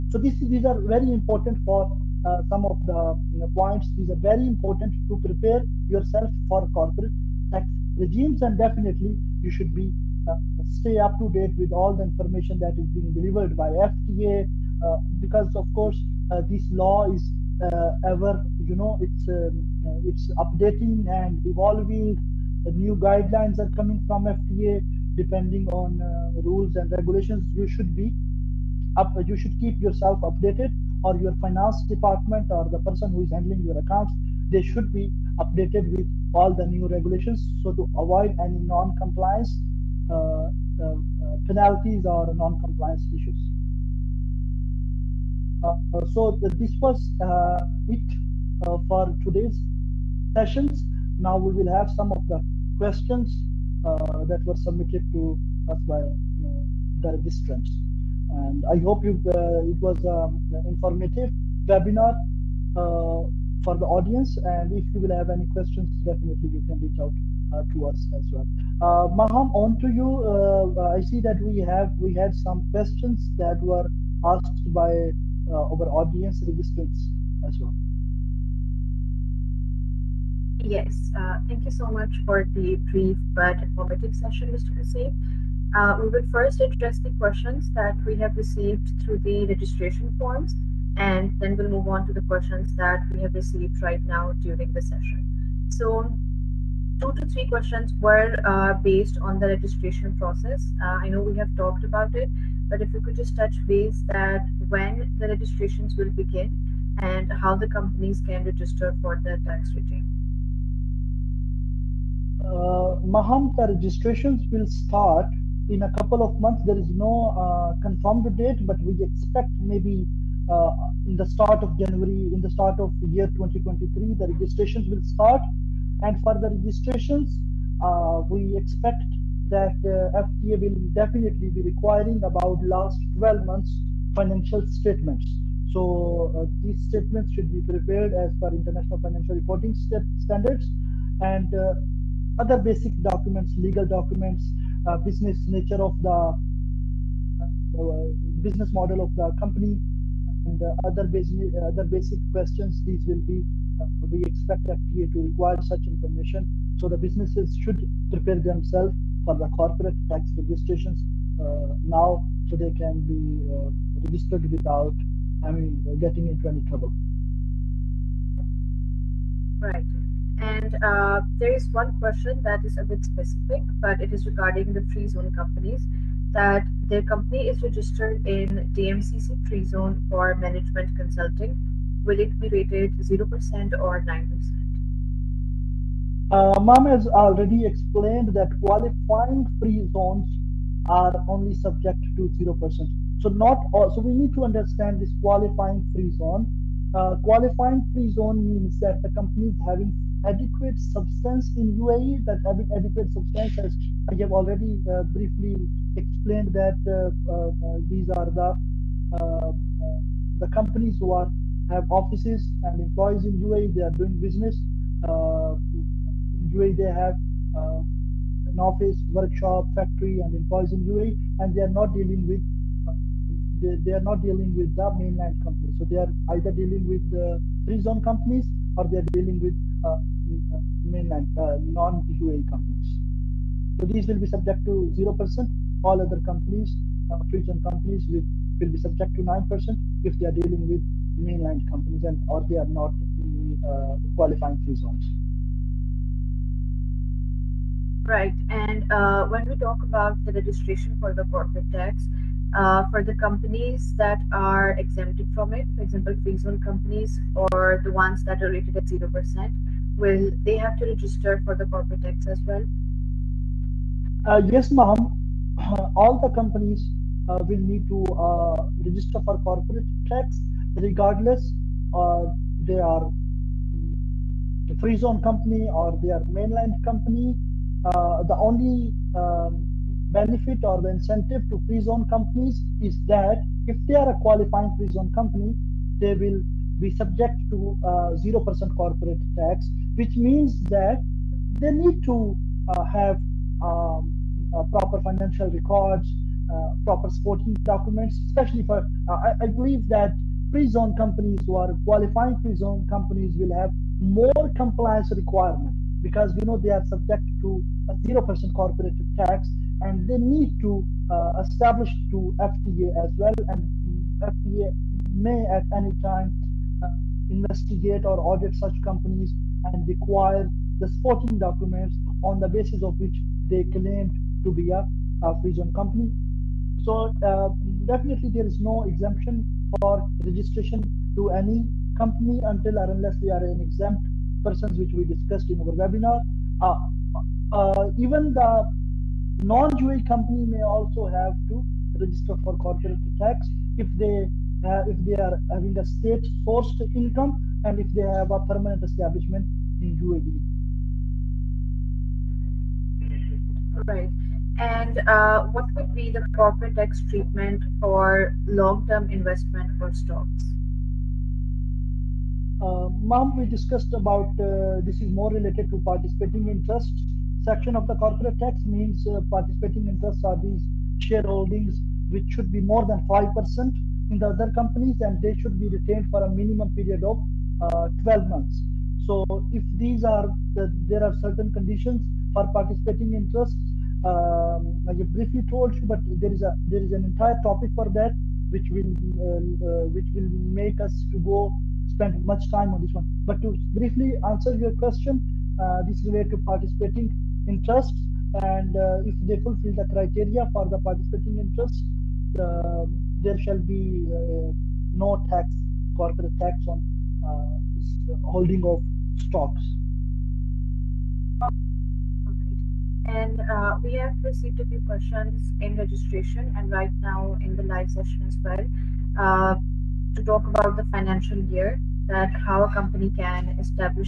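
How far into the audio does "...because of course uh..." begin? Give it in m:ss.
0:15.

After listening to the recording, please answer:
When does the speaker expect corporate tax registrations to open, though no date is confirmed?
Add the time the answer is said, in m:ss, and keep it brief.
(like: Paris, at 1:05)
Start of January 2023, at 2:01.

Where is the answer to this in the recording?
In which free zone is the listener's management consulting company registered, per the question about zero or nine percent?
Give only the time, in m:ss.
2:58.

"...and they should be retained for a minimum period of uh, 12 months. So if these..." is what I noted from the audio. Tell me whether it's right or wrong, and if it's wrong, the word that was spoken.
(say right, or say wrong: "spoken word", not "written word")
right.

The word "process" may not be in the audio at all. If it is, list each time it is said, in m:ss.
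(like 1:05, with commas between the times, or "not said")
1:40.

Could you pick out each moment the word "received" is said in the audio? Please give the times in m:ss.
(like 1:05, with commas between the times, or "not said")
1:28, 1:33, 6:54.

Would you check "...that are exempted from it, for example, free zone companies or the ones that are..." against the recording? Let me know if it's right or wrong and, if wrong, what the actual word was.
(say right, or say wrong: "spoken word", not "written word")
right.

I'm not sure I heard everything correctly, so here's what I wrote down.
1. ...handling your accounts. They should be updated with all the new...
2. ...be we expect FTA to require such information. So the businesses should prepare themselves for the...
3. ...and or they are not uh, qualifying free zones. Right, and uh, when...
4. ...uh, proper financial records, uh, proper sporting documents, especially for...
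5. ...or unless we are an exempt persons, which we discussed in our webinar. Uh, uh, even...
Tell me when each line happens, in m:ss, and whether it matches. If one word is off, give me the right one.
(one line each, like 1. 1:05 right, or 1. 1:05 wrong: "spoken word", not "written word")
1. 0:33 right
2. 2:33 right
3. 4:02 right
4. 4:54 right
5. 5:32 right.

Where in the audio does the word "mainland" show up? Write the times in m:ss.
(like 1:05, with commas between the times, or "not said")
3:44, 3:50, 4:01, 4:36.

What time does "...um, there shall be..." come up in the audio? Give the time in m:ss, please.
6:42.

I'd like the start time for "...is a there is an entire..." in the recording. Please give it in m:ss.
6:26.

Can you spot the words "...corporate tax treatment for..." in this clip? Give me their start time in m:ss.
5:56.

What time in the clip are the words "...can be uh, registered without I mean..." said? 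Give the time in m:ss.
2:42.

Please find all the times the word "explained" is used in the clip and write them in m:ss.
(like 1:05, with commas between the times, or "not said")
3:07, 3:25.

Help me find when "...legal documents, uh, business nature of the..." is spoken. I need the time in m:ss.
2:23.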